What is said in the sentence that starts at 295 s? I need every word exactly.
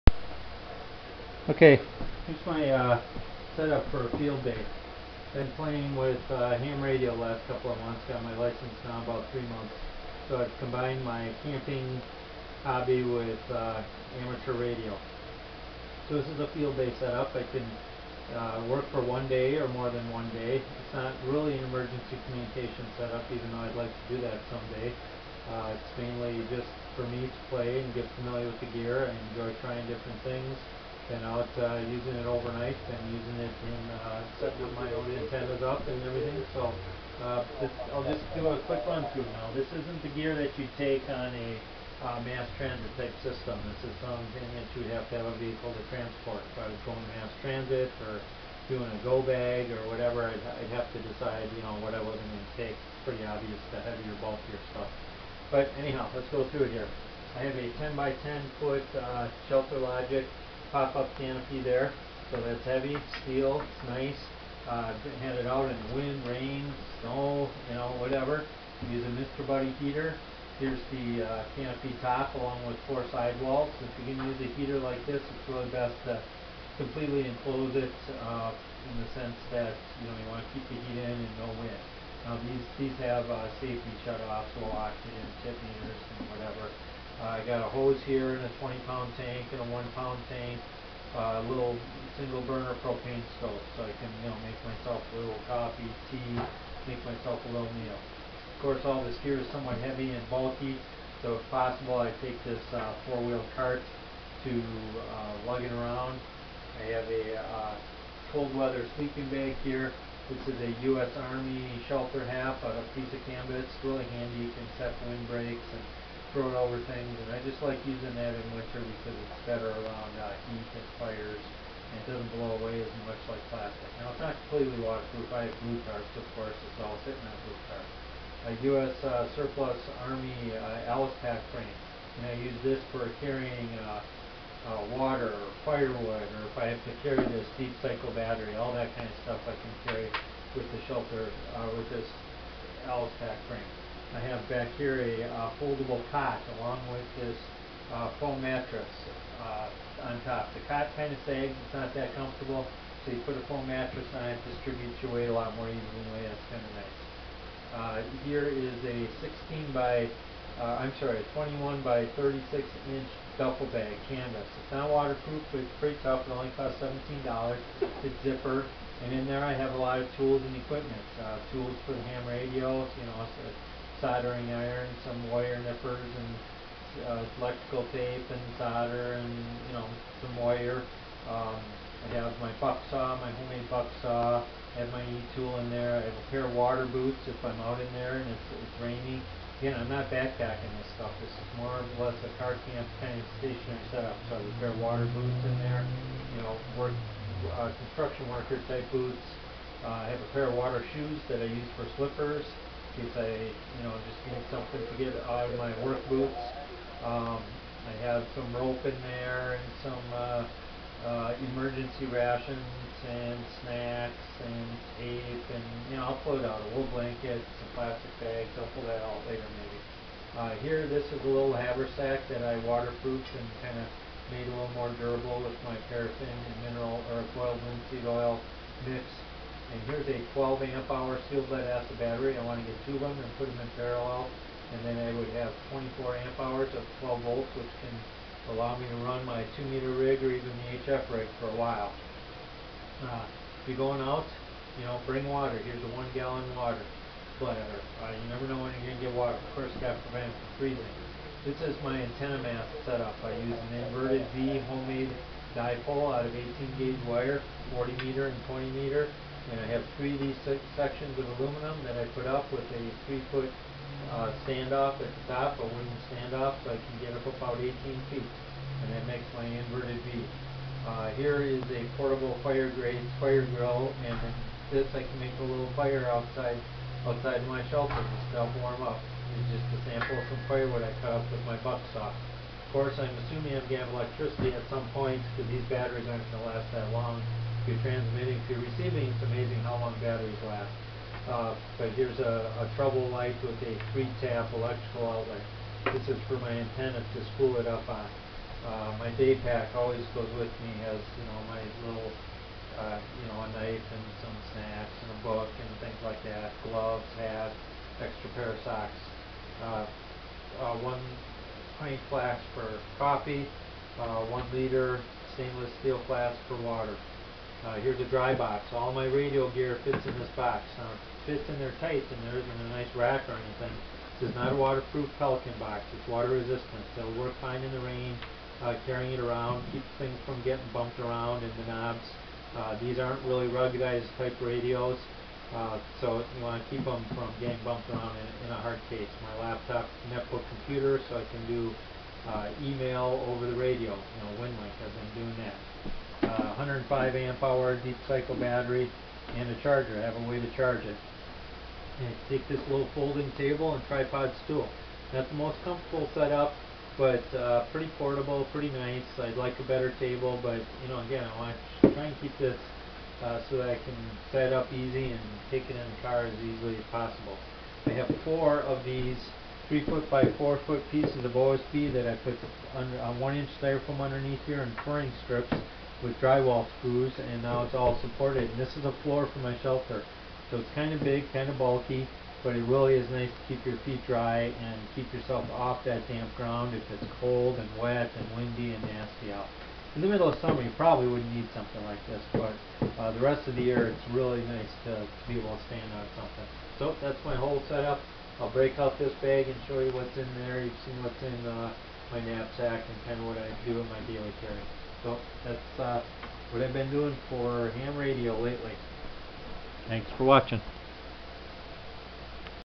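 This is for my antenna to spool it up on.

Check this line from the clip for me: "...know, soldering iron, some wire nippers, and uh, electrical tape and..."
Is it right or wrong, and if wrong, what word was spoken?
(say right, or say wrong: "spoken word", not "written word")
right.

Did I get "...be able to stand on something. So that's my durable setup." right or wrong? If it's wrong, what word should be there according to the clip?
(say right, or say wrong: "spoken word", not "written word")
wrong: "whole", not "durable".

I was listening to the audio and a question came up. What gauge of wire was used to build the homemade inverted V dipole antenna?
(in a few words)
18 gauge.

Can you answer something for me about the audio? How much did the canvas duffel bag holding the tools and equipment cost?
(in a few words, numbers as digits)
$17.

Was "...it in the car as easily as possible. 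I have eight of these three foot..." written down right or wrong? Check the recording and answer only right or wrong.
wrong.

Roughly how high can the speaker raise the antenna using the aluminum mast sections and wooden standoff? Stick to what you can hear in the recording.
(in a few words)
18 feet.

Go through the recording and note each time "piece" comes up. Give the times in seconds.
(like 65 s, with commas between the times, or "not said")
112 s, 370 s.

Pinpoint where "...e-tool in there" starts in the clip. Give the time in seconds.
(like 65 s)
185 s.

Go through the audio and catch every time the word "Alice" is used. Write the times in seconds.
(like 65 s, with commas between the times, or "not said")
130 s, 142 s.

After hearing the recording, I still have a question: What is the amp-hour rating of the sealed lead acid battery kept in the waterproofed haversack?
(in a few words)
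12 amp hour.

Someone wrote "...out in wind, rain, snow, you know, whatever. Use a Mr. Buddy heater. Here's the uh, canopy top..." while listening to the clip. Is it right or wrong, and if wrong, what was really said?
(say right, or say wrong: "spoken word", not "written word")
right.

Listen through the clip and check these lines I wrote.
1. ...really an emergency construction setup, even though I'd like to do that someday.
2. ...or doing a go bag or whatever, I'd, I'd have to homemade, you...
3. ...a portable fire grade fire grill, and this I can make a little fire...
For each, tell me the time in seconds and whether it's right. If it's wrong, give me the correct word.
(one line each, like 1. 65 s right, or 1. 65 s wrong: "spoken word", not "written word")
1. 21 s wrong: "communication", not "construction"
2. 48 s wrong: "decide", not "homemade"
3. 271 s right.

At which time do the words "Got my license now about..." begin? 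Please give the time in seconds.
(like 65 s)
8 s.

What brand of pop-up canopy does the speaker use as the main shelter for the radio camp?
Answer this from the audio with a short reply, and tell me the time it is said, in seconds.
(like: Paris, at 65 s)
Shelter Logic, at 59 s.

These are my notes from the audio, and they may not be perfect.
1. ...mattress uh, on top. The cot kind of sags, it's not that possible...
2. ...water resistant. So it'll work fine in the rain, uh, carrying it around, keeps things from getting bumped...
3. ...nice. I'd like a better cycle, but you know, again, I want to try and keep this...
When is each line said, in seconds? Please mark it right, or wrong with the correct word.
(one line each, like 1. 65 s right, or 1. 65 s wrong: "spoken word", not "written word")
1. 148 s wrong: "comfortable", not "possible"
2. 326 s right
3. 358 s wrong: "table", not "cycle".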